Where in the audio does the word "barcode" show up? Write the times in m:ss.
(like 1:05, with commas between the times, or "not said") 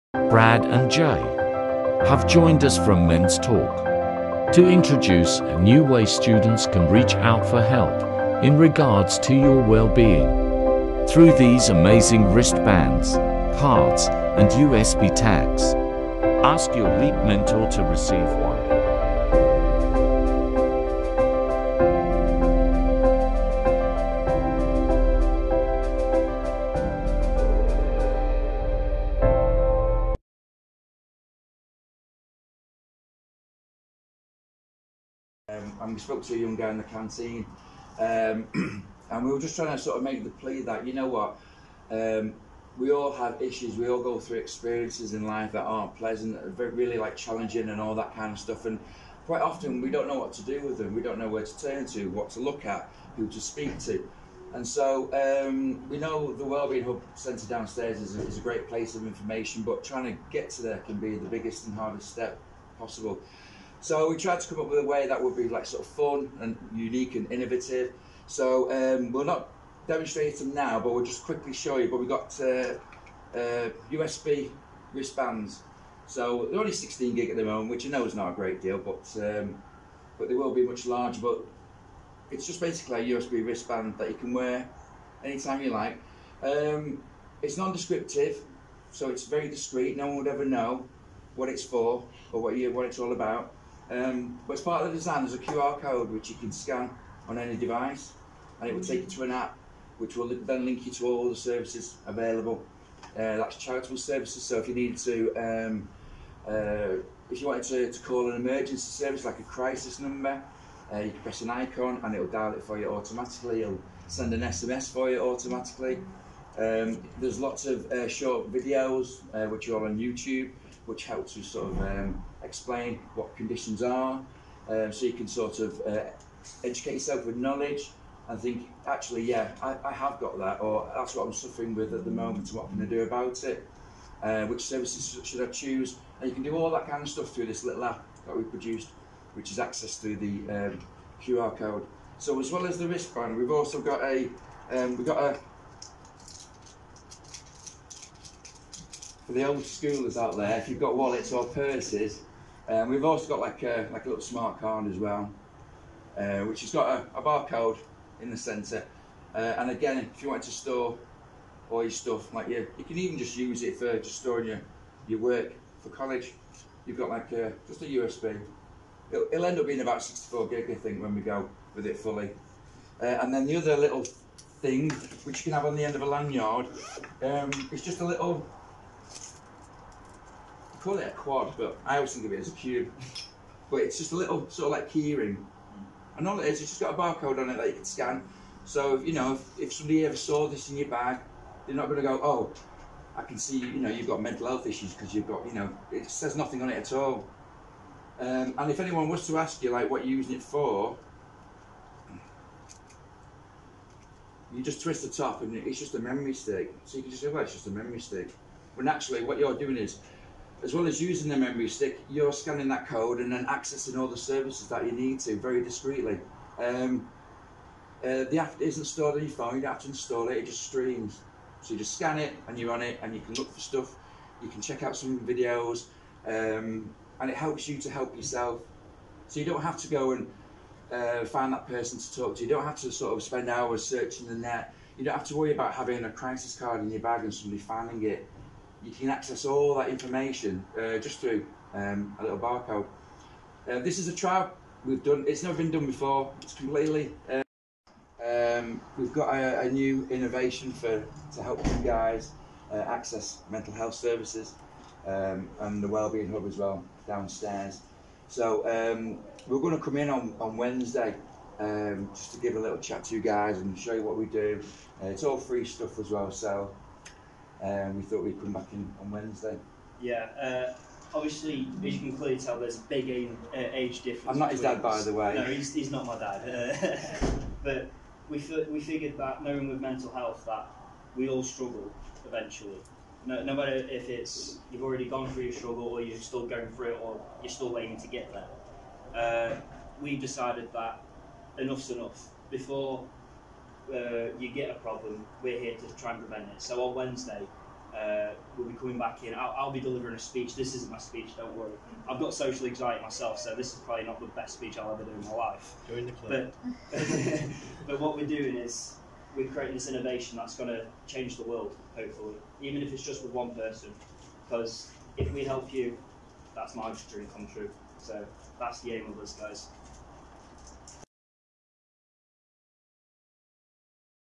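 2:37, 3:06, 4:02.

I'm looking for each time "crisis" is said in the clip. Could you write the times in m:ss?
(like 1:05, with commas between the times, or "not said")
1:49, 3:56.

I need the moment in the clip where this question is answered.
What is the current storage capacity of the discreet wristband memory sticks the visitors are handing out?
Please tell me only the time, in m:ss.
1:16.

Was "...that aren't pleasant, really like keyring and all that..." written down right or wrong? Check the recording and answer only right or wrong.
wrong.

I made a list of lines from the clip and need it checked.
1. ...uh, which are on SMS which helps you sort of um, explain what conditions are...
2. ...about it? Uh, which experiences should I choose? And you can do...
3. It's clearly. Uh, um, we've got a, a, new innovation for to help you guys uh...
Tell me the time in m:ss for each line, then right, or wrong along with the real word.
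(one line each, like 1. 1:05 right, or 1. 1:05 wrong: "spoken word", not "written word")
1. 1:59 wrong: "YouTube", not "SMS"
2. 2:13 wrong: "services", not "experiences"
3. 4:06 wrong: "completely", not "clearly".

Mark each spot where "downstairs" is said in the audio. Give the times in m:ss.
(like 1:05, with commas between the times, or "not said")
0:57, 4:17.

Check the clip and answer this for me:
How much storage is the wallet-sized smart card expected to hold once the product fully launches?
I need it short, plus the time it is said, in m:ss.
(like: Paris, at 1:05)
64 gig, at 2:50.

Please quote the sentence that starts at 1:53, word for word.
It'll send an SMS for you automatically.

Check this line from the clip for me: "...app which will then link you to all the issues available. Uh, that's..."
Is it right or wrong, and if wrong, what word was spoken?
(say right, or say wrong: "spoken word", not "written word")
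wrong: "services", not "issues".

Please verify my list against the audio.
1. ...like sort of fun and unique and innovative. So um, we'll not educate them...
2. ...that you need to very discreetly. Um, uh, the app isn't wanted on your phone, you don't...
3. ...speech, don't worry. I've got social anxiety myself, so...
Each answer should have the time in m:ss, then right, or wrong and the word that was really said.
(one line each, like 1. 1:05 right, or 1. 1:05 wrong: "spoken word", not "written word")
1. 1:05 wrong: "demonstrate", not "educate"
2. 3:34 wrong: "stored", not "wanted"
3. 5:00 right.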